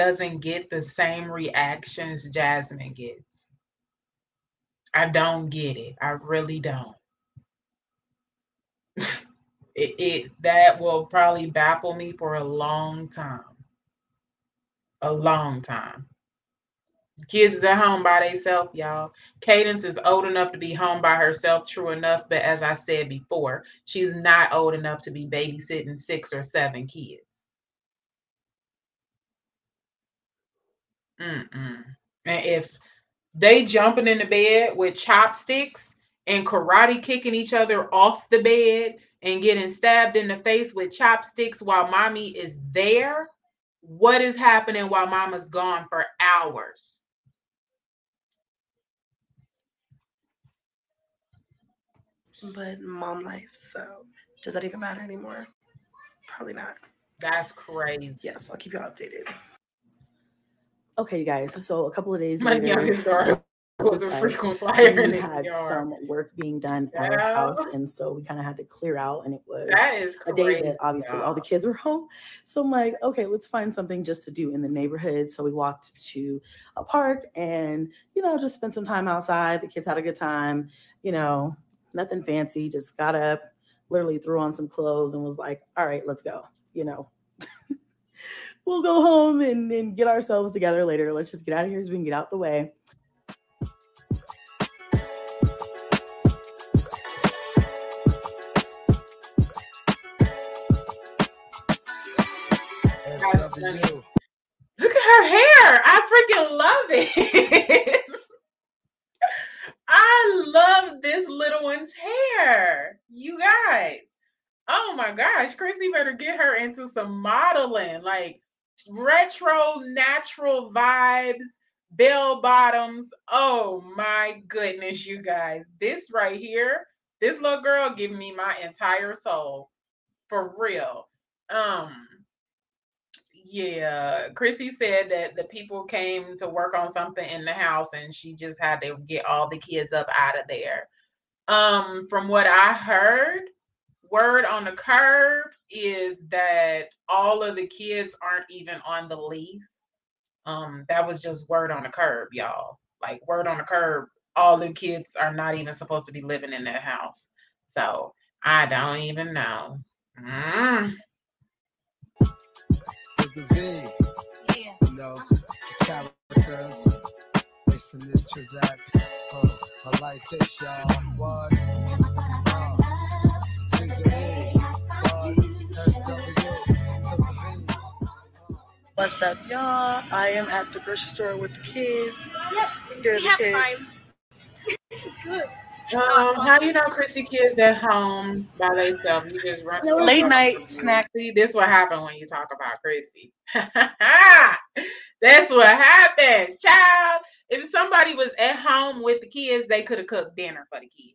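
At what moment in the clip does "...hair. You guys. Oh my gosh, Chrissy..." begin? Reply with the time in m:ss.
1:51.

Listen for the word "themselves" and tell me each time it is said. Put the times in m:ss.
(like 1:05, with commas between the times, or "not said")
0:18, 3:08.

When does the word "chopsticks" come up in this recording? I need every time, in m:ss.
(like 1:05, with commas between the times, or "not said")
0:34, 0:40.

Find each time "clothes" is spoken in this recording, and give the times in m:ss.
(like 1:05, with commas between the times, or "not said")
1:24.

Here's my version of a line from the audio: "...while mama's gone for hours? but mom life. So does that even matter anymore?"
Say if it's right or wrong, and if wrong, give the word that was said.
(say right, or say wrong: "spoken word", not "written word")
right.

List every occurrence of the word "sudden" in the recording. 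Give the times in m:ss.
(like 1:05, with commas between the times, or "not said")
not said.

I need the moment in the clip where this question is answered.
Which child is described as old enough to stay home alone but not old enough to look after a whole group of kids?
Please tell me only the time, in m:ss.
0:19.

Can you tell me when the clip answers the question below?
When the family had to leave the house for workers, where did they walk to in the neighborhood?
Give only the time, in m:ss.
1:16.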